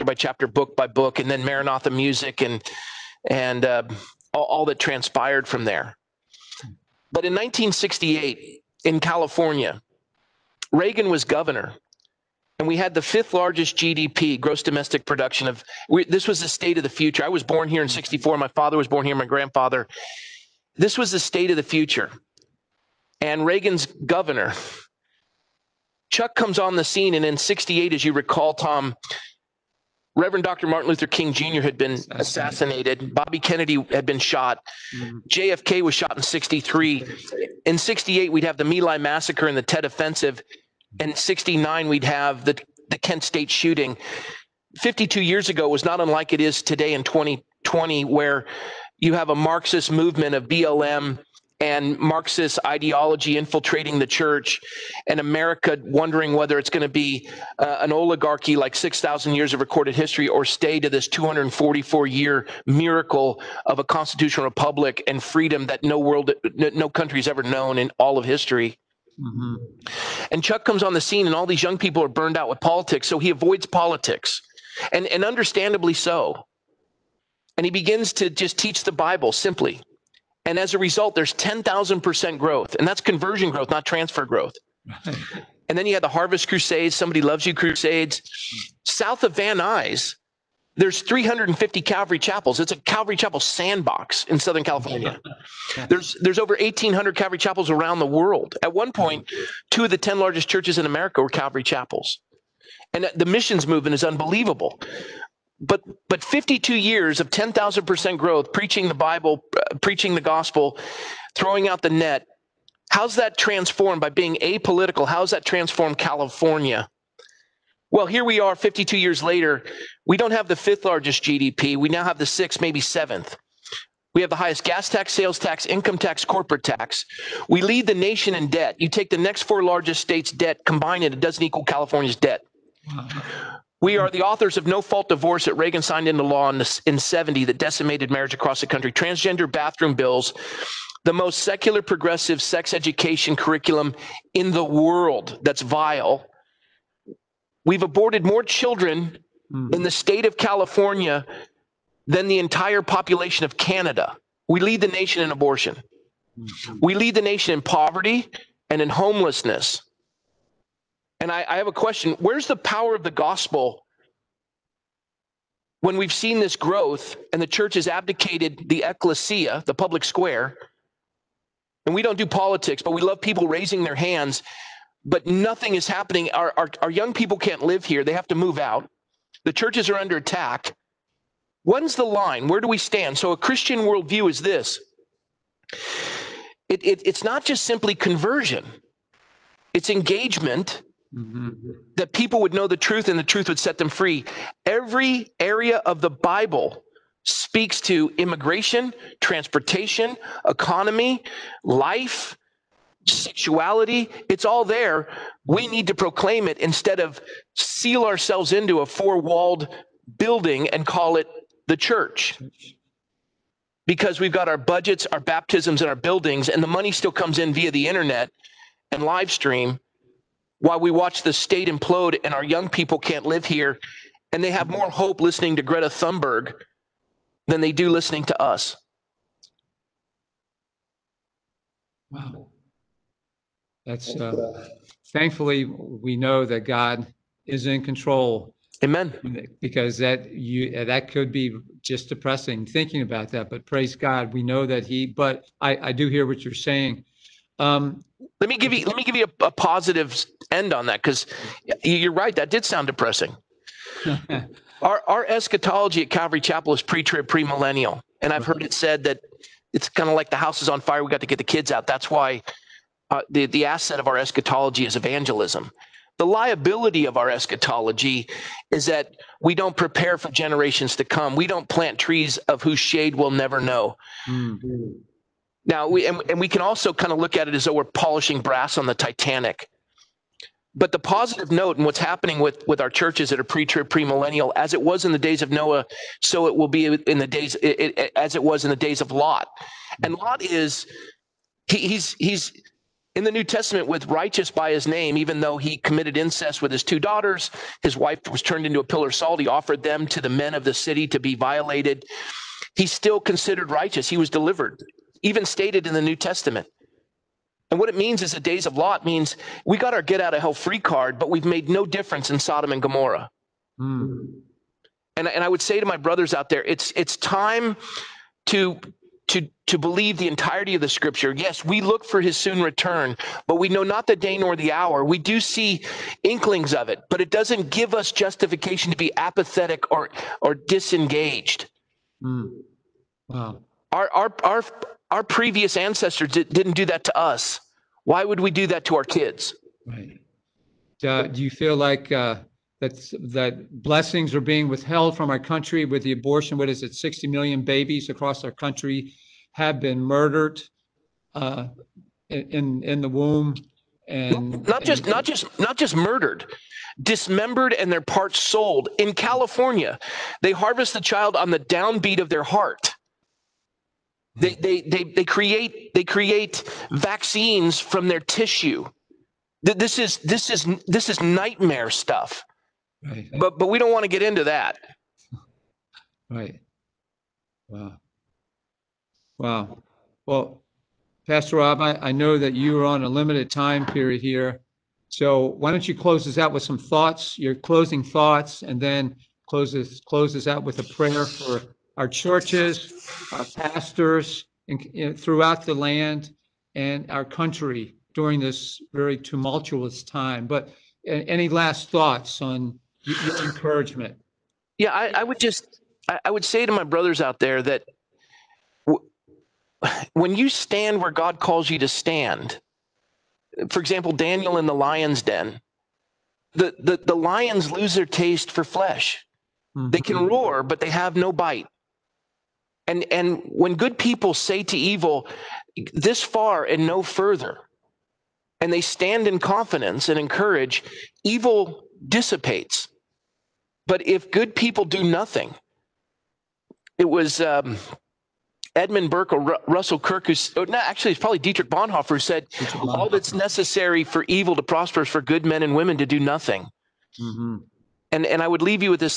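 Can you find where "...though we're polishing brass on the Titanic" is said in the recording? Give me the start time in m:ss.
4:37.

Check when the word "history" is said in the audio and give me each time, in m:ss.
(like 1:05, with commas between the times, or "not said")
0:59, 1:08.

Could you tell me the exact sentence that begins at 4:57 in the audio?
His wife was turned into a pillar of salt.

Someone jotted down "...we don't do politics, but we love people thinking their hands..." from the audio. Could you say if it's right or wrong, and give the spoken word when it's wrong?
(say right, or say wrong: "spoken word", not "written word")
wrong: "raising", not "thinking".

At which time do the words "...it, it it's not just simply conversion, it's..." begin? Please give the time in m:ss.
3:06.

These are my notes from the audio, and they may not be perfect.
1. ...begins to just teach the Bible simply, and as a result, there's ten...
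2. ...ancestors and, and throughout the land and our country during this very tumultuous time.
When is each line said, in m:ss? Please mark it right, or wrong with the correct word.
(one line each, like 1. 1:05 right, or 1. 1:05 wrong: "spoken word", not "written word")
1. 1:17 right
2. 6:33 wrong: "pastors", not "ancestors".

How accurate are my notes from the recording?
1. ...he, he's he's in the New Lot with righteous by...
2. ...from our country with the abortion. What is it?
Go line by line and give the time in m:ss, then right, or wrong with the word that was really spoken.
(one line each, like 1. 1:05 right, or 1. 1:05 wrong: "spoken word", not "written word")
1. 4:51 wrong: "Testament", not "Lot"
2. 5:45 right.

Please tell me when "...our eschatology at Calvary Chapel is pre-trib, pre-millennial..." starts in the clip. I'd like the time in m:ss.
4:15.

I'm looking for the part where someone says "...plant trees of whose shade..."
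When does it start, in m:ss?
4:31.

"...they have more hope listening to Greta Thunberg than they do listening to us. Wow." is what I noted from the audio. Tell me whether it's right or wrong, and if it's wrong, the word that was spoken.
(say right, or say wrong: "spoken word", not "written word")
right.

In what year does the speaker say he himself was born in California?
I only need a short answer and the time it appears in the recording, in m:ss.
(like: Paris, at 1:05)
1964, at 0:17.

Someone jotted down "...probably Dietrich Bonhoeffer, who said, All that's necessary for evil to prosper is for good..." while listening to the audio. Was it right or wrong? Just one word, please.
right.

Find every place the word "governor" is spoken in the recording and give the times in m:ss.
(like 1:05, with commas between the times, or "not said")
0:11, 0:23.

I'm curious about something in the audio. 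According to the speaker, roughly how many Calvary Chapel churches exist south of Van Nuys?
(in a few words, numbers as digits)
350.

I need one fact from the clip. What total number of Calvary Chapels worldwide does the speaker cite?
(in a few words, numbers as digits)
over 1,800.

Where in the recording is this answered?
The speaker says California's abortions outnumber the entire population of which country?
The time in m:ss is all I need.
2:33.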